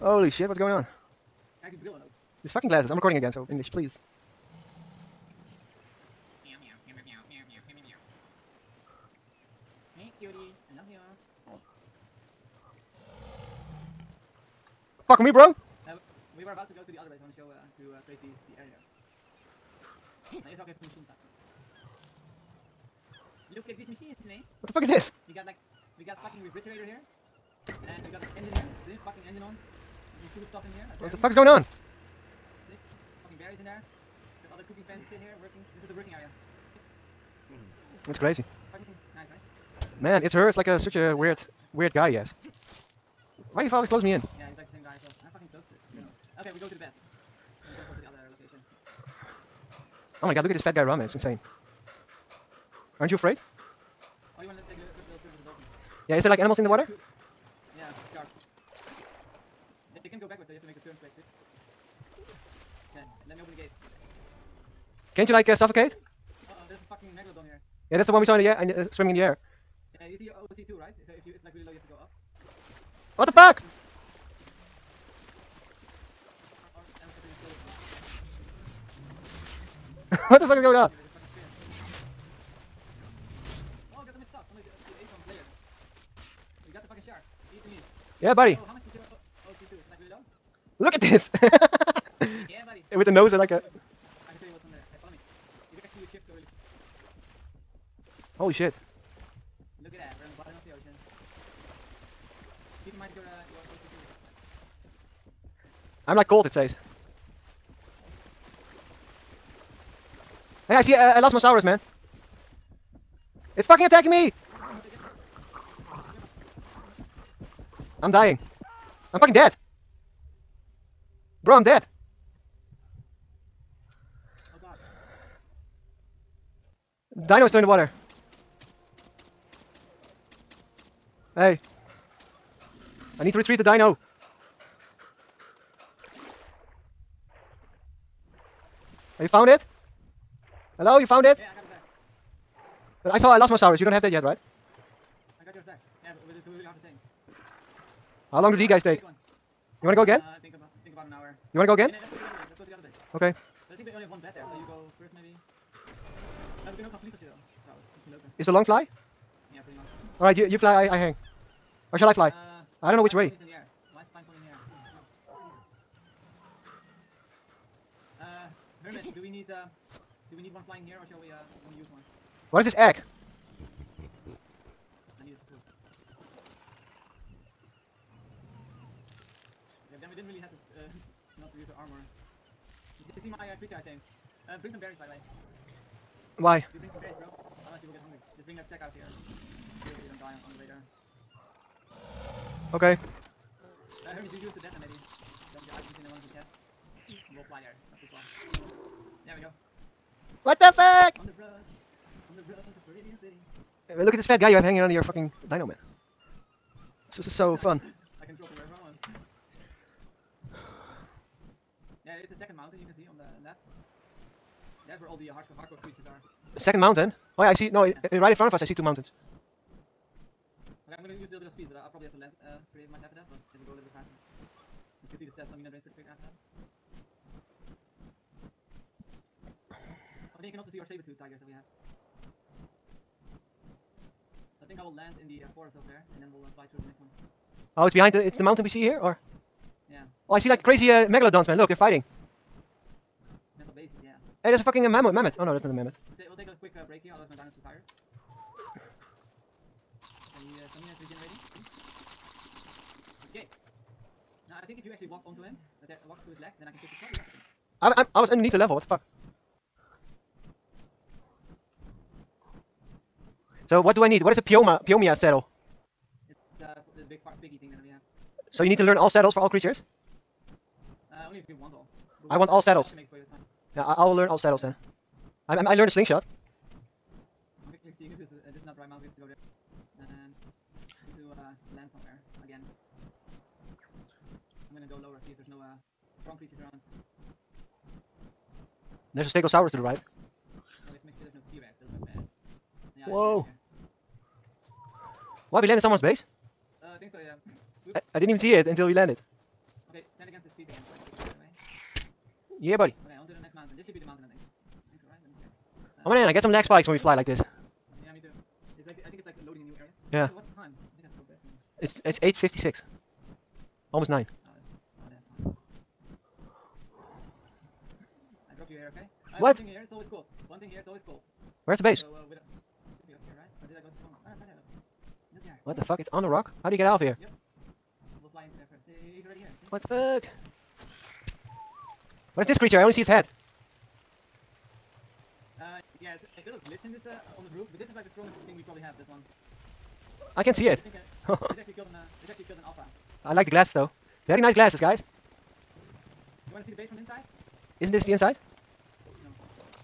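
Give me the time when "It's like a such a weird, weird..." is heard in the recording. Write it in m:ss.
0:40.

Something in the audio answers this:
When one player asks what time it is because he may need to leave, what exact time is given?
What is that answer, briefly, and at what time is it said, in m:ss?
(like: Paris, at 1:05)
8:56, at 5:12.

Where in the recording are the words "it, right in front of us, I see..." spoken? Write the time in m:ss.
3:38.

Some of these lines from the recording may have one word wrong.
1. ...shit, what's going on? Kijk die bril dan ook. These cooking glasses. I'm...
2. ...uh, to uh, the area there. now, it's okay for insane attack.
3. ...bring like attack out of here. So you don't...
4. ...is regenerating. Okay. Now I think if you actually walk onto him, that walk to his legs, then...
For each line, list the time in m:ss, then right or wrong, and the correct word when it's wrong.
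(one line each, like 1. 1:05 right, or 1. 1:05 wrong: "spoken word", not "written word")
1. 0:00 wrong: "fucking", not "cooking"
2. 0:17 wrong: "machine", not "insane"
3. 3:08 wrong: "stack", not "attack"
4. 4:10 right.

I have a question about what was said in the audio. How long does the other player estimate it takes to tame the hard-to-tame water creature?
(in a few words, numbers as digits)
About an hour.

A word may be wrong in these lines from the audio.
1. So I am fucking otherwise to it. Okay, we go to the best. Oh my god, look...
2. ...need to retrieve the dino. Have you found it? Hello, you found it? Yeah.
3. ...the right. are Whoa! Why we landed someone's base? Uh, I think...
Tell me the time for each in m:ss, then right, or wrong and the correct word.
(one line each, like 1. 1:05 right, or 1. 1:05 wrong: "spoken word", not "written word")
1. 0:45 wrong: "close", not "otherwise"
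2. 2:13 right
3. 4:49 right.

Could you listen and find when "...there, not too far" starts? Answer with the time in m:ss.
3:17.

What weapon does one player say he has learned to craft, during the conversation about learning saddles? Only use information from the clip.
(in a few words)
Slingshot.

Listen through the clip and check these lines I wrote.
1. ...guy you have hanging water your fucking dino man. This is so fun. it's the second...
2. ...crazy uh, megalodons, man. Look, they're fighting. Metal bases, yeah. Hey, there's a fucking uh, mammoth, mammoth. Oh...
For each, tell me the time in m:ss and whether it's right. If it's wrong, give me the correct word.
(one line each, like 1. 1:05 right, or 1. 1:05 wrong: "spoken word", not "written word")
1. 3:24 wrong: "under", not "water"
2. 4:00 right.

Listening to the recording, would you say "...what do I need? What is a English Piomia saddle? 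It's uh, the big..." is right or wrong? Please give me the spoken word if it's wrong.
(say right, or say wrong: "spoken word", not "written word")
wrong: "Pioma", not "English".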